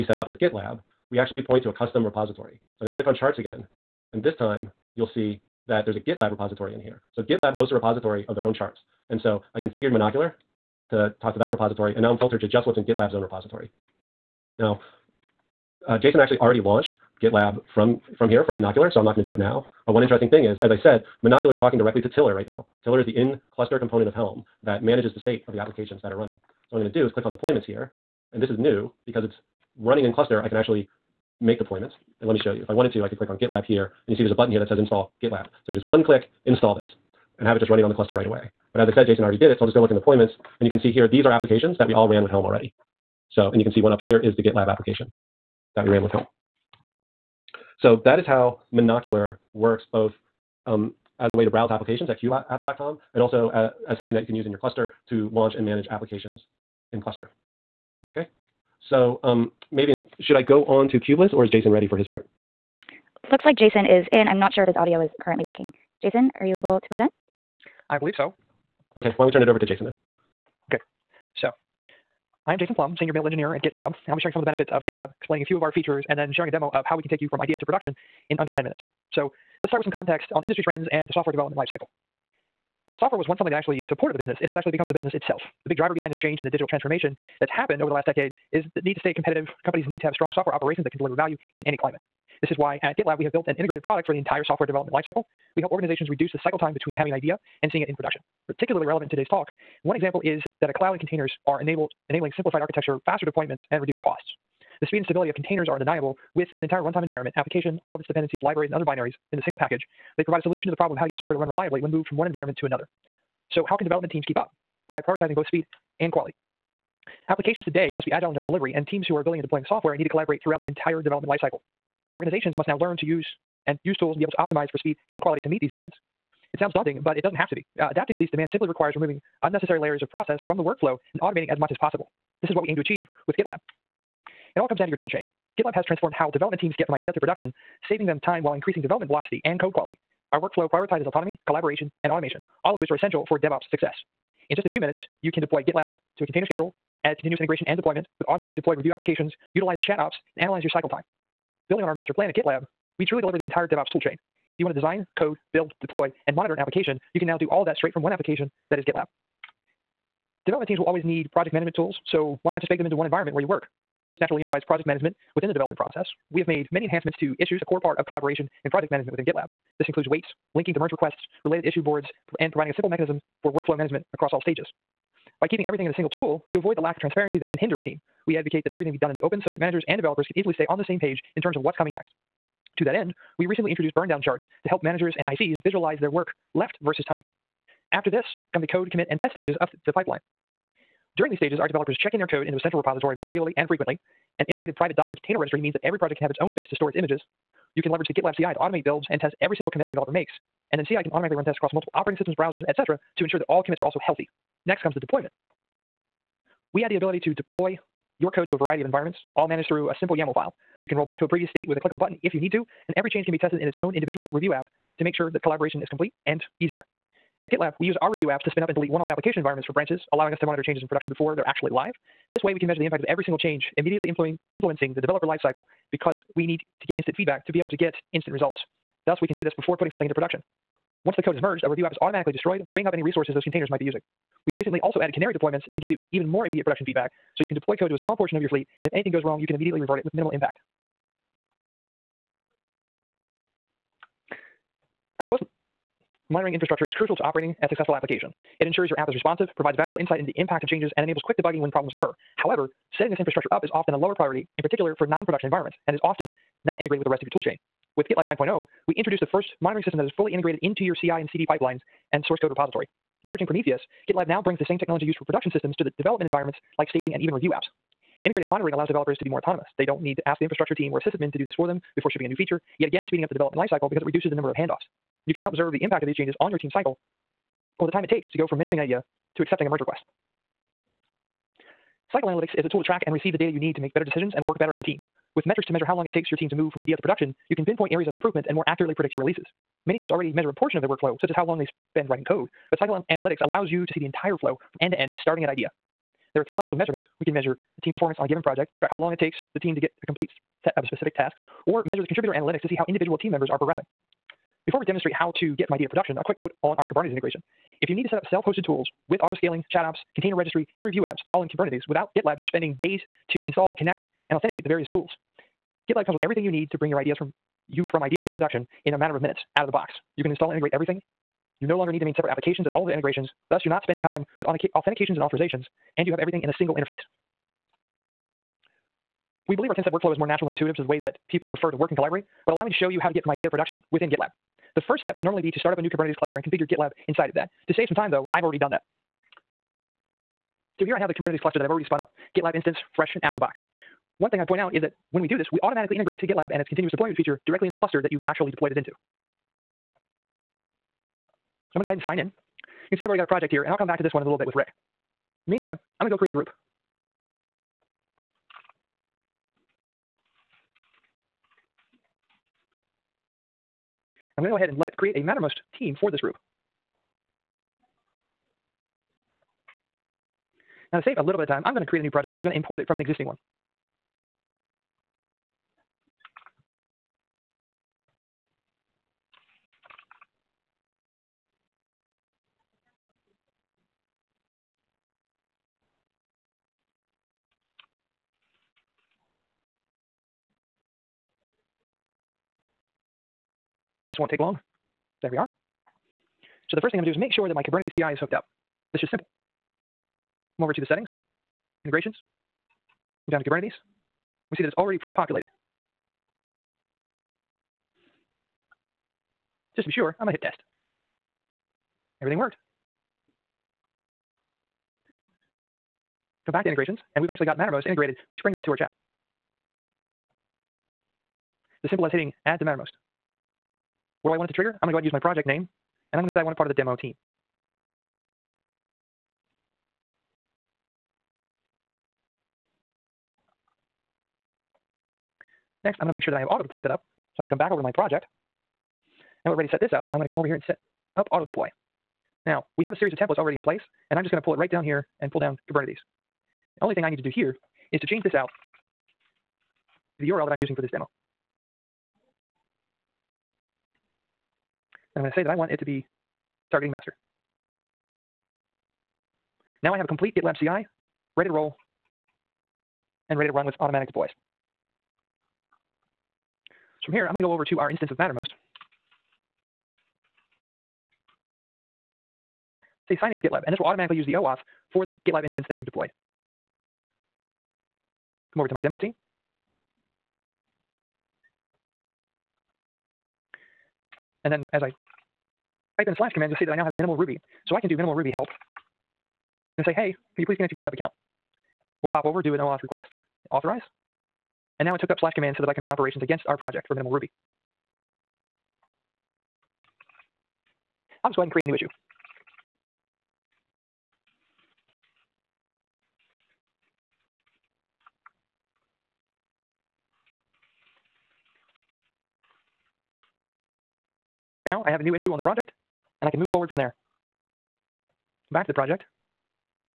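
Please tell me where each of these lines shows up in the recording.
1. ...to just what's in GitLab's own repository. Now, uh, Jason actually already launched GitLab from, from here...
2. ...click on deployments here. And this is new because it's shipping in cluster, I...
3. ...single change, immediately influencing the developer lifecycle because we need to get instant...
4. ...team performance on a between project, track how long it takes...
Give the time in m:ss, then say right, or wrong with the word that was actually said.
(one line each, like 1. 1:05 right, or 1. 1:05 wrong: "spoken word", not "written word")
1. 0:12 right
2. 0:27 wrong: "running", not "shipping"
3. 3:43 right
4. 4:57 wrong: "given", not "between".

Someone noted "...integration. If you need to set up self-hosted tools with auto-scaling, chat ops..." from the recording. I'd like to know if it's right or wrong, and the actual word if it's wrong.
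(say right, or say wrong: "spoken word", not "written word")
right.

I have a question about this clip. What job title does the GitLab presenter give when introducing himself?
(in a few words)
Senior Build Engineer.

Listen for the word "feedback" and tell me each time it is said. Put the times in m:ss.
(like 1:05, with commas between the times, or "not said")
3:47, 3:56.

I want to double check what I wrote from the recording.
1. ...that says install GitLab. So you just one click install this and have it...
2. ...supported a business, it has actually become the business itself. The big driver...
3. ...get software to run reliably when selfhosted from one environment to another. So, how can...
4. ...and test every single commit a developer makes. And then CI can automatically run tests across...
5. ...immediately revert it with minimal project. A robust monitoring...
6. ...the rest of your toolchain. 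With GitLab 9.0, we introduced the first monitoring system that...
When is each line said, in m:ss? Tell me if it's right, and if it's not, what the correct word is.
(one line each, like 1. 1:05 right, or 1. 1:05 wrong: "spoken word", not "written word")
1. 0:34 right
2. 1:23 right
3. 1:51 wrong: "moved", not "selfhosted"
4. 3:19 right
5. 3:59 wrong: "impact", not "project"
6. 4:17 right.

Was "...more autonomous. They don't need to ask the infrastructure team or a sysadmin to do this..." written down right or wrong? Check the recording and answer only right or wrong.
right.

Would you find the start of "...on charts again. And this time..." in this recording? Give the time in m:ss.
0:03.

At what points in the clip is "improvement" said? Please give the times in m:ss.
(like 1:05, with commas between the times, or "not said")
4:48.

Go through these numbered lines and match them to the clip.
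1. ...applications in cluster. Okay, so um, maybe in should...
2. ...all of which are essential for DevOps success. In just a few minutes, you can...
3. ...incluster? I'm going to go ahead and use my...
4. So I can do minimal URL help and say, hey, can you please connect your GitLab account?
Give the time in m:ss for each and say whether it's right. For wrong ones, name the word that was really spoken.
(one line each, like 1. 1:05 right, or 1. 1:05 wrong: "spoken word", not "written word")
1. 0:55 right
2. 2:22 right
3. 7:04 wrong: "trigger", not "incluster"
4. 8:07 wrong: "Ruby", not "URL".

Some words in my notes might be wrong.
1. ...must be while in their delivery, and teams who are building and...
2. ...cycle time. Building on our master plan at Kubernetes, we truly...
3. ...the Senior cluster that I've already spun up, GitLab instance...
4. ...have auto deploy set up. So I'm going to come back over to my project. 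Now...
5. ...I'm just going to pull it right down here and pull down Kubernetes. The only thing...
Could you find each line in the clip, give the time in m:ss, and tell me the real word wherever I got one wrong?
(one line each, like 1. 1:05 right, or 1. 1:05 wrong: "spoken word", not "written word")
1. 1:57 wrong: "agile", not "while"
2. 2:30 wrong: "GitLab", not "Kubernetes"
3. 5:41 wrong: "Kubernetes", not "Senior"
4. 7:16 right
5. 7:24 right.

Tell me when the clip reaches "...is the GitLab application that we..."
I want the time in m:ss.
0:44.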